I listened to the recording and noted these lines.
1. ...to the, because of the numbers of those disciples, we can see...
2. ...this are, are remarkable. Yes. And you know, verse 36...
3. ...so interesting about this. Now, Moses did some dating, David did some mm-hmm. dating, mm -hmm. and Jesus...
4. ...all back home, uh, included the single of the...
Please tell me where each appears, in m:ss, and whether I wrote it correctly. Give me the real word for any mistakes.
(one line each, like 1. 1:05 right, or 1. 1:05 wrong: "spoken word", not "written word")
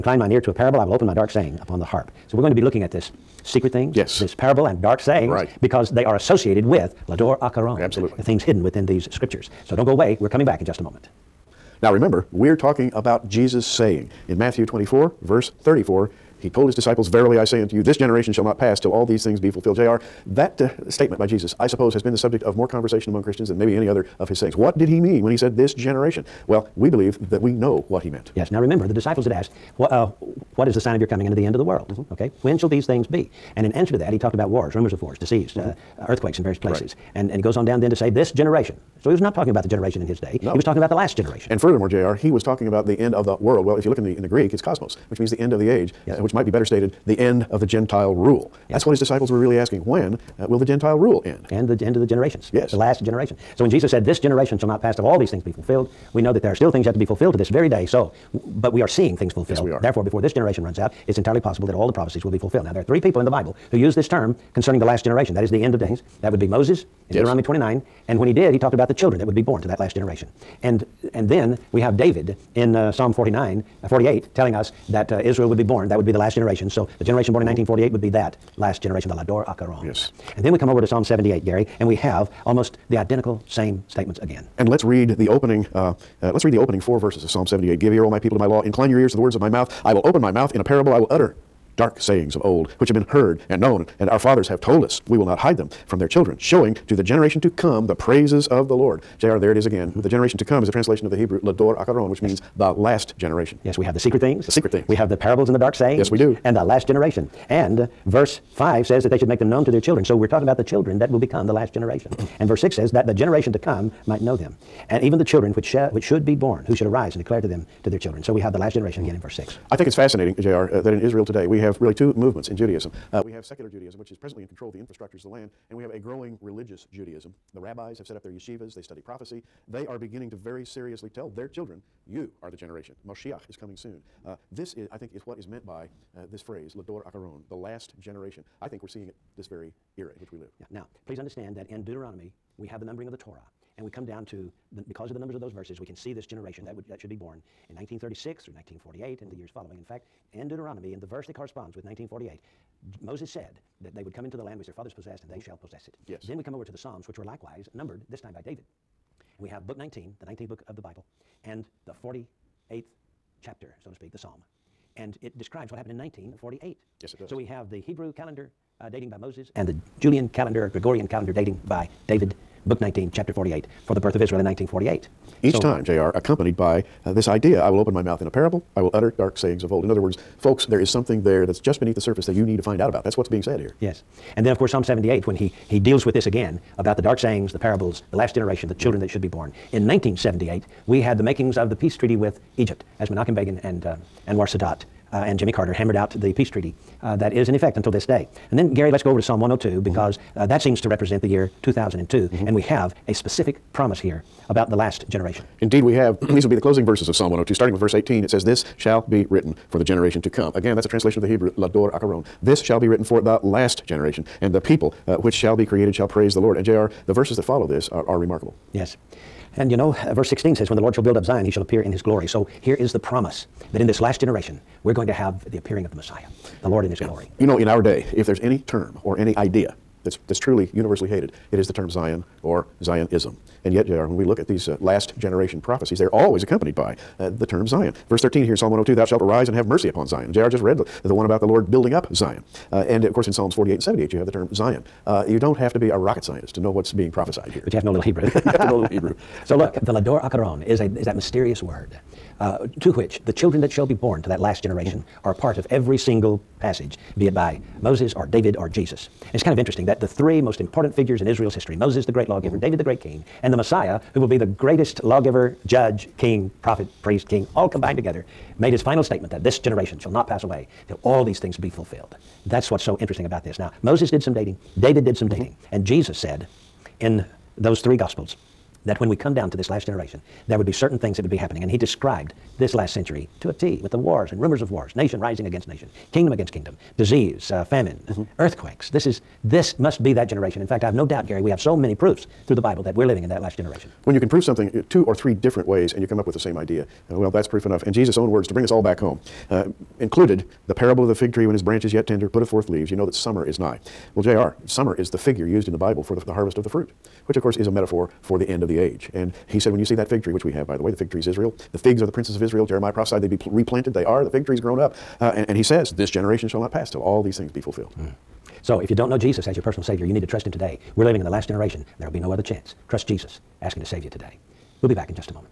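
1. 2:24 wrong: "verses", not "disciples"
2. 3:37 wrong: "16", not "36"
3. 4:32 right
4. 4:58 wrong: "parable", not "single".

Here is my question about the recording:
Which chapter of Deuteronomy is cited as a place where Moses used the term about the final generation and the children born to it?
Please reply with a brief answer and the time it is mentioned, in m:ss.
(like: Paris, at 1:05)
29, at 1:07.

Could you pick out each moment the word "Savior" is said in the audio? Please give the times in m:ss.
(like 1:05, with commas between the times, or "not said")
5:19.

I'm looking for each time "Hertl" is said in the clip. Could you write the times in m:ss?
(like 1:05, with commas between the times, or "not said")
not said.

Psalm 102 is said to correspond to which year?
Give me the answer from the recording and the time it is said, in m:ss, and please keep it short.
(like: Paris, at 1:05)
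2002, at 3:21.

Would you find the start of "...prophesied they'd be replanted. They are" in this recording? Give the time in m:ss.
5:12.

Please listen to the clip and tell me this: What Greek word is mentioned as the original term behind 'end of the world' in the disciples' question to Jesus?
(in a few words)
cosmos.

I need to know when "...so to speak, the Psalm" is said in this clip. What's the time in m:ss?
2:43.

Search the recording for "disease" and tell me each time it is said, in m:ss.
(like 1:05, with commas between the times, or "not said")
0:35, 4:46.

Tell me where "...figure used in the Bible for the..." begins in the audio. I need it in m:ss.
5:05.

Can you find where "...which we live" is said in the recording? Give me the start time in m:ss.
2:20.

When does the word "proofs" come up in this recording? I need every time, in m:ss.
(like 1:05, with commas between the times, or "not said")
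4:51, 4:57.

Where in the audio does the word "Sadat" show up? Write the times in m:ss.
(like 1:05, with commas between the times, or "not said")
3:14.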